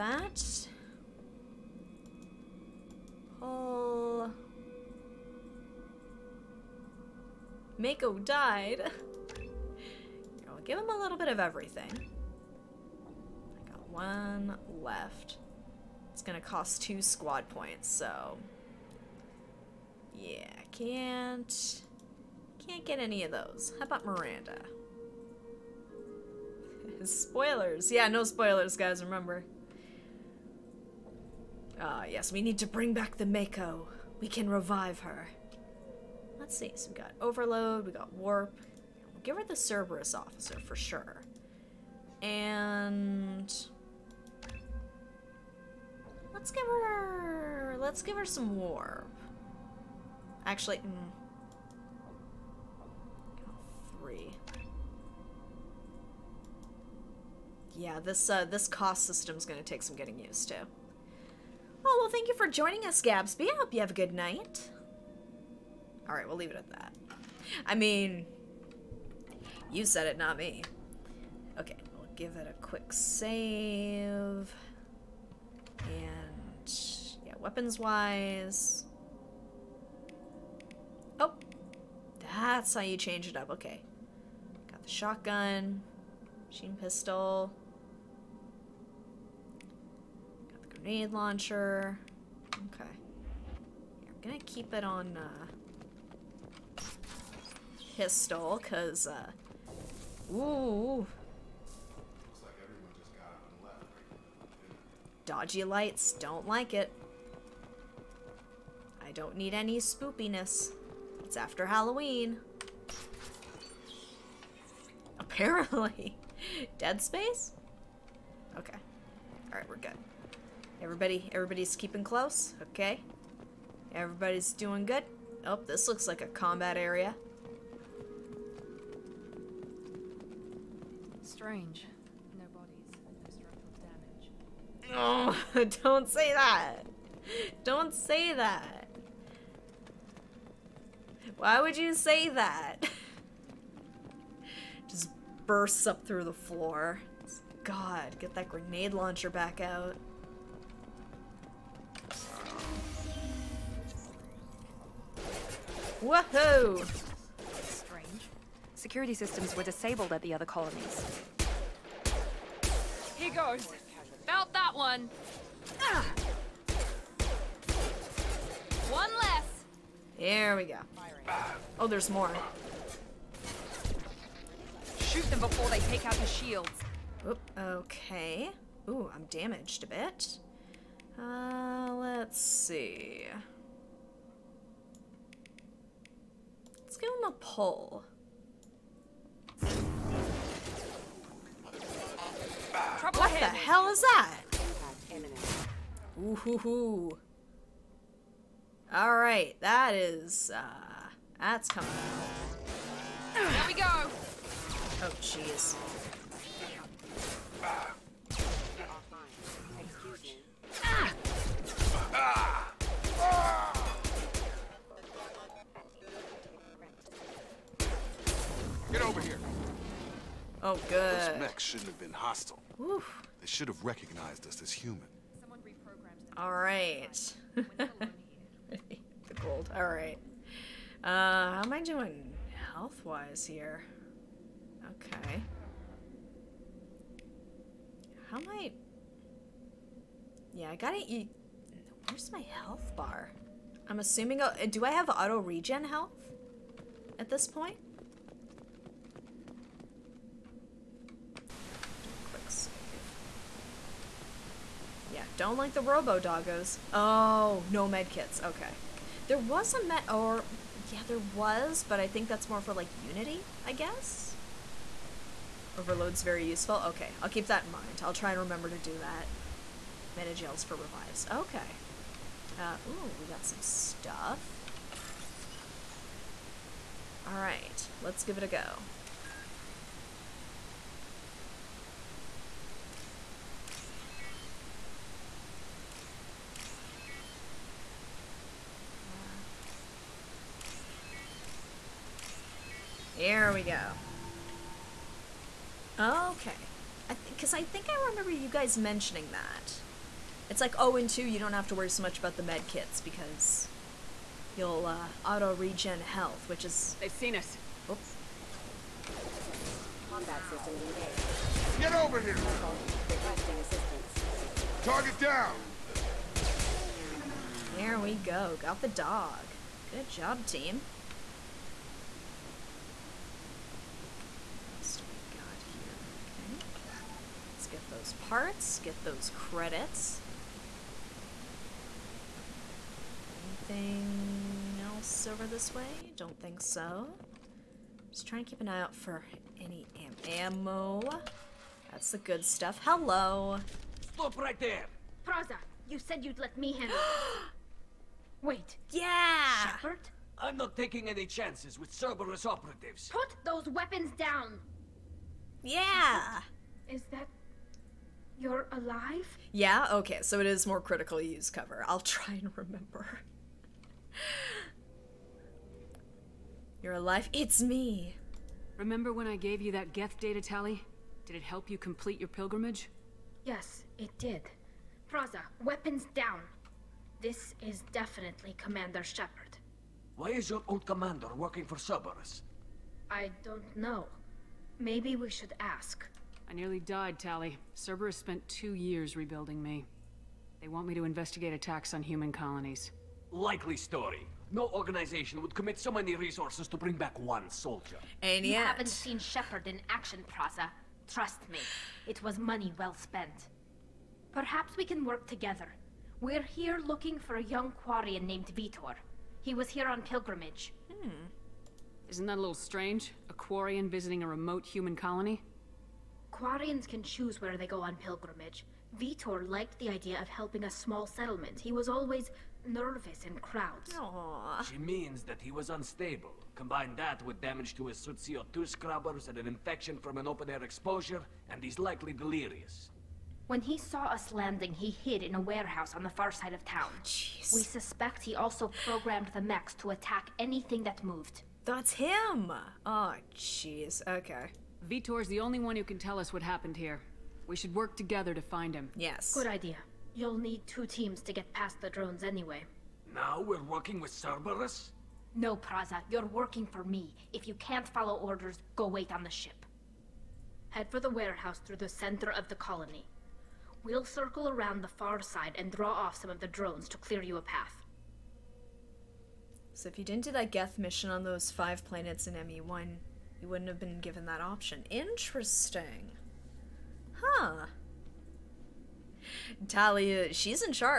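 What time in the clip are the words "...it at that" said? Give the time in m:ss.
1:06.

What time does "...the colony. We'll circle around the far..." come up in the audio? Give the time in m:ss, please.
7:42.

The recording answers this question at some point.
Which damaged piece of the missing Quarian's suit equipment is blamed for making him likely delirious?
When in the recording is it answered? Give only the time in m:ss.
7:08.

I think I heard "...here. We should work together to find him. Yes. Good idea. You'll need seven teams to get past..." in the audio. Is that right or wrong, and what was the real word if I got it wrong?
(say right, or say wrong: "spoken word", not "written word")
wrong: "two", not "seven".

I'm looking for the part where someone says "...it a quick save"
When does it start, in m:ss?
1:12.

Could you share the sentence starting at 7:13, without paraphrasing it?
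When he saw us landing, he hid in a warehouse on the far side of town.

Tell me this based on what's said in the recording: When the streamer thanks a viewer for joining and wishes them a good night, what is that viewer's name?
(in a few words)
Gabsby.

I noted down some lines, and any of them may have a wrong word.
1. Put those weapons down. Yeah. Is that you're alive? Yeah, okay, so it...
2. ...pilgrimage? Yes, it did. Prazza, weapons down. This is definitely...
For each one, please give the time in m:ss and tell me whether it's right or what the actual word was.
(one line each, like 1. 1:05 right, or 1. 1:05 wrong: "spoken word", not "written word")
1. 5:53 right
2. 6:12 right.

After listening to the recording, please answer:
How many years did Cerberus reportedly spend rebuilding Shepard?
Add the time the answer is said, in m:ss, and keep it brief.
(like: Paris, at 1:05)
2, at 6:28.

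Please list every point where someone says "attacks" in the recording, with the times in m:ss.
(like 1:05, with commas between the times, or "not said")
6:31, 7:19.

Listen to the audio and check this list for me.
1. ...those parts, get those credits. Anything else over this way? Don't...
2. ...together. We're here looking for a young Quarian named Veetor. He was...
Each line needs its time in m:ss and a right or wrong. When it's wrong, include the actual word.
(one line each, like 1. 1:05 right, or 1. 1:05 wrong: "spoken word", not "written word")
1. 5:27 right
2. 6:45 right.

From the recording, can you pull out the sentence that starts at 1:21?
Oh, that's how you change it up.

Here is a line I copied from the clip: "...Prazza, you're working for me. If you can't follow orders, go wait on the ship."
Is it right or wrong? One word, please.
right.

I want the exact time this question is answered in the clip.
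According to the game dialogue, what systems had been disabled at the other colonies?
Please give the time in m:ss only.
2:38.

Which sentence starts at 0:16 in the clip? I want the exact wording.
It's gonna cost two squad points, so...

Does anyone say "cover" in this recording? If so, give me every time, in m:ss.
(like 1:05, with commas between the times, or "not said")
6:01.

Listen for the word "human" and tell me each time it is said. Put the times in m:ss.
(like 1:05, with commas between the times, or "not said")
3:44, 6:32, 6:54.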